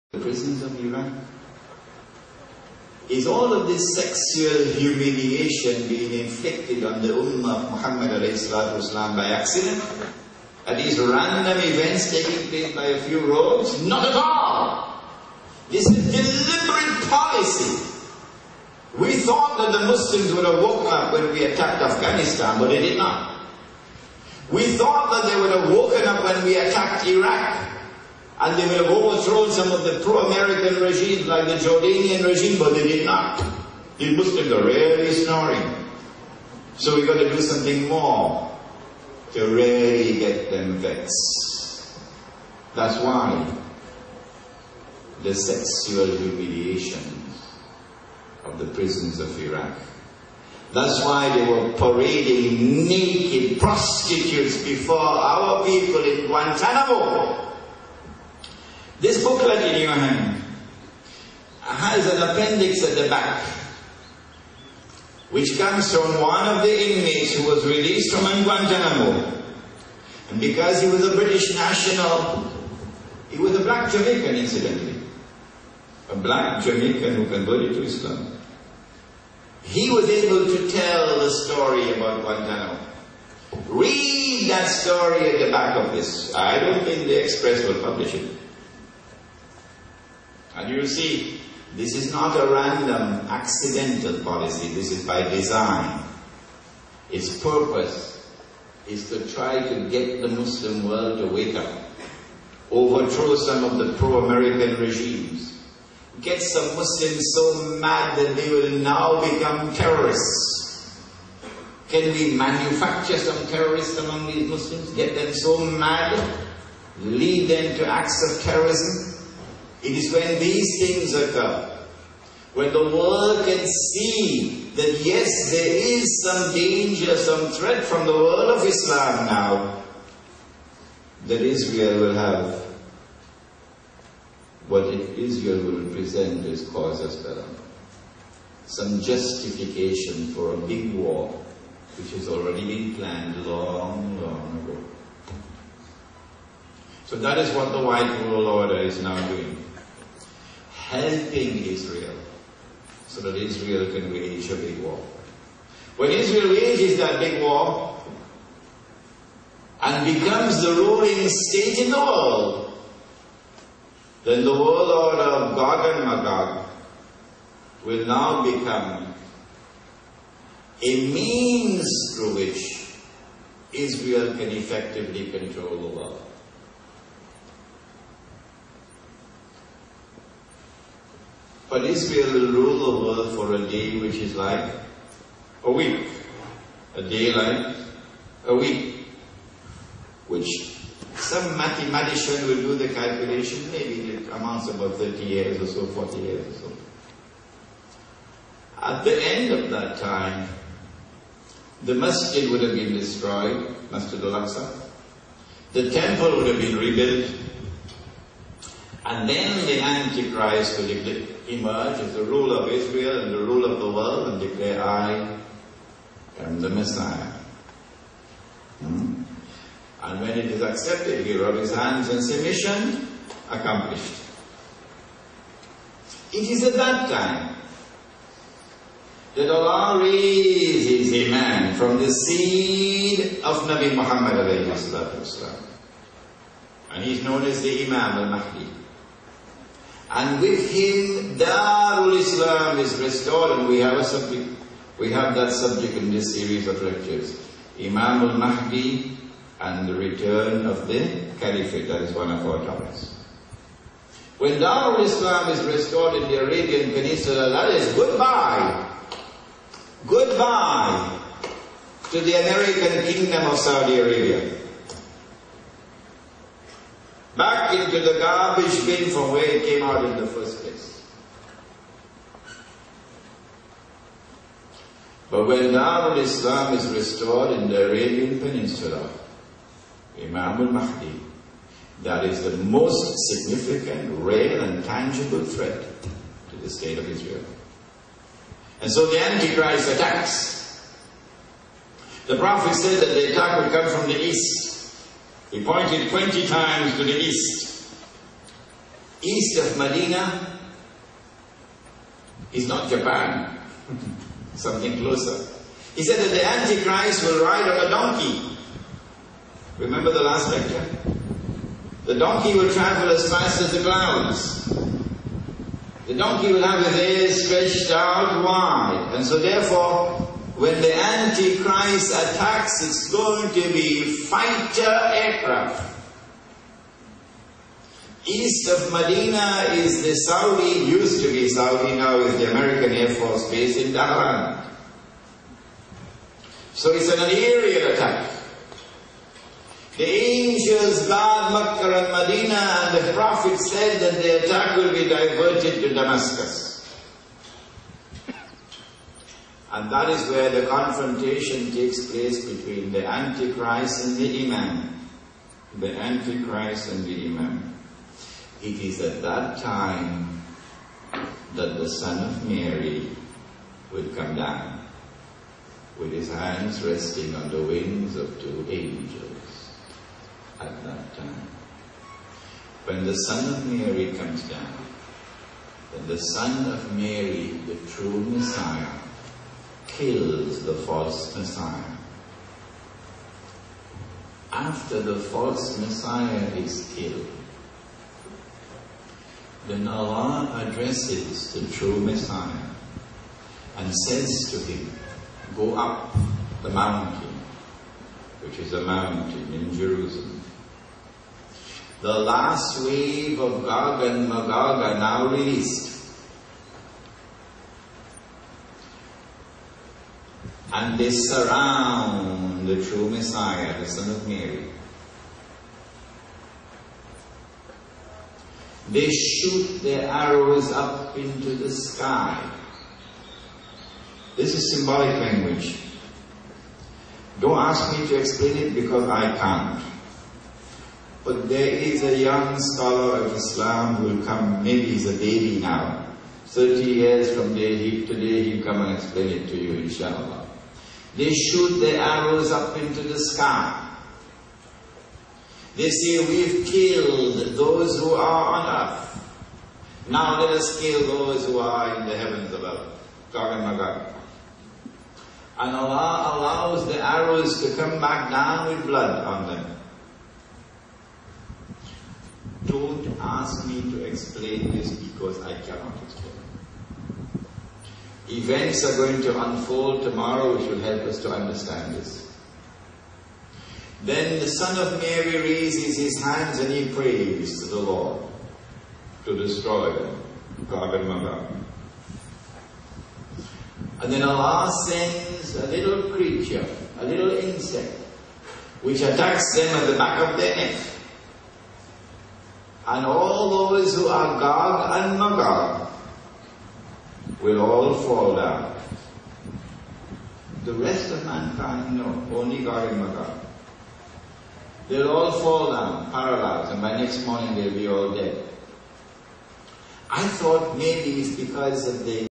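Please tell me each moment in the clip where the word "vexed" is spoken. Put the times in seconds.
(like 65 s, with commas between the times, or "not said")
40 s.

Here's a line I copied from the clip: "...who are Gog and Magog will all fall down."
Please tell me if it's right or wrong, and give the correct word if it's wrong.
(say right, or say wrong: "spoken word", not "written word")
right.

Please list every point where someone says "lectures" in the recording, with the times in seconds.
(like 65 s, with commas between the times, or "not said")
246 s, 310 s.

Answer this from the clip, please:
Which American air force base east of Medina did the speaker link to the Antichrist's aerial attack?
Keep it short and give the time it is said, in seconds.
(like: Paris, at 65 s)
Dhahran, at 333 s.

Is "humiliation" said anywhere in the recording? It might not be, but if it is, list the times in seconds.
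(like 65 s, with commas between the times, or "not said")
4 s, 46 s.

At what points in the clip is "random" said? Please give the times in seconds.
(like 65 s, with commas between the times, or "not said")
10 s, 92 s.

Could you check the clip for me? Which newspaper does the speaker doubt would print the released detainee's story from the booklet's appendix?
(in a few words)
The Express.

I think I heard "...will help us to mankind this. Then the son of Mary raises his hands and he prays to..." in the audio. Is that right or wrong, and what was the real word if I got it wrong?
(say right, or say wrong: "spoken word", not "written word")
wrong: "understand", not "mankind".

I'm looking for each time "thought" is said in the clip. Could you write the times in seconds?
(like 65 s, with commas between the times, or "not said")
19 s, 24 s, 510 s.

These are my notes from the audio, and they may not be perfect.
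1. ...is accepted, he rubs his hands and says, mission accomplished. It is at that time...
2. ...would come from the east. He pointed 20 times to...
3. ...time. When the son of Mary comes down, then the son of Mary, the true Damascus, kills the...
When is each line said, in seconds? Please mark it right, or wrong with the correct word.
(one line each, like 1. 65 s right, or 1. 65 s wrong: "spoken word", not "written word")
1. 220 s right
2. 293 s right
3. 371 s wrong: "Messiah", not "Damascus".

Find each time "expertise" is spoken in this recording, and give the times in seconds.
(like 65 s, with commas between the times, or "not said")
not said.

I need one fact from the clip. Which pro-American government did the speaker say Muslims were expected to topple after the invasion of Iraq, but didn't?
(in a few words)
Jordanian regime.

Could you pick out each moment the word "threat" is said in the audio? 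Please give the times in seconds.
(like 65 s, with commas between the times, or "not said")
127 s, 285 s.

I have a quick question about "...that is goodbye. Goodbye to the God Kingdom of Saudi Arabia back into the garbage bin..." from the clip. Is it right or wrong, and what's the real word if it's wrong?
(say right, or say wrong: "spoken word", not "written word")
wrong: "American", not "God".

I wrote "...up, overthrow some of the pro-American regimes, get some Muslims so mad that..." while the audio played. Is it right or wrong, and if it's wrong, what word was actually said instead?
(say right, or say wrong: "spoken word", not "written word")
right.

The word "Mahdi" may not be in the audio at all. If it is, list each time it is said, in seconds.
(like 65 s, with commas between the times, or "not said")
238 s, 248 s, 280 s.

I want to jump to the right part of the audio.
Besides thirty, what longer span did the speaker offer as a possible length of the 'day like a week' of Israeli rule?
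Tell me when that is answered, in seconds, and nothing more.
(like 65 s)
195 s.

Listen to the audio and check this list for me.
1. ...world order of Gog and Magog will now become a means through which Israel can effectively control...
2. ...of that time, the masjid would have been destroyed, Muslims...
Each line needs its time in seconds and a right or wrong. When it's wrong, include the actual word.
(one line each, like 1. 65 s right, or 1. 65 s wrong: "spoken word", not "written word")
1. 164 s right
2. 199 s wrong: "Masjid", not "Muslims".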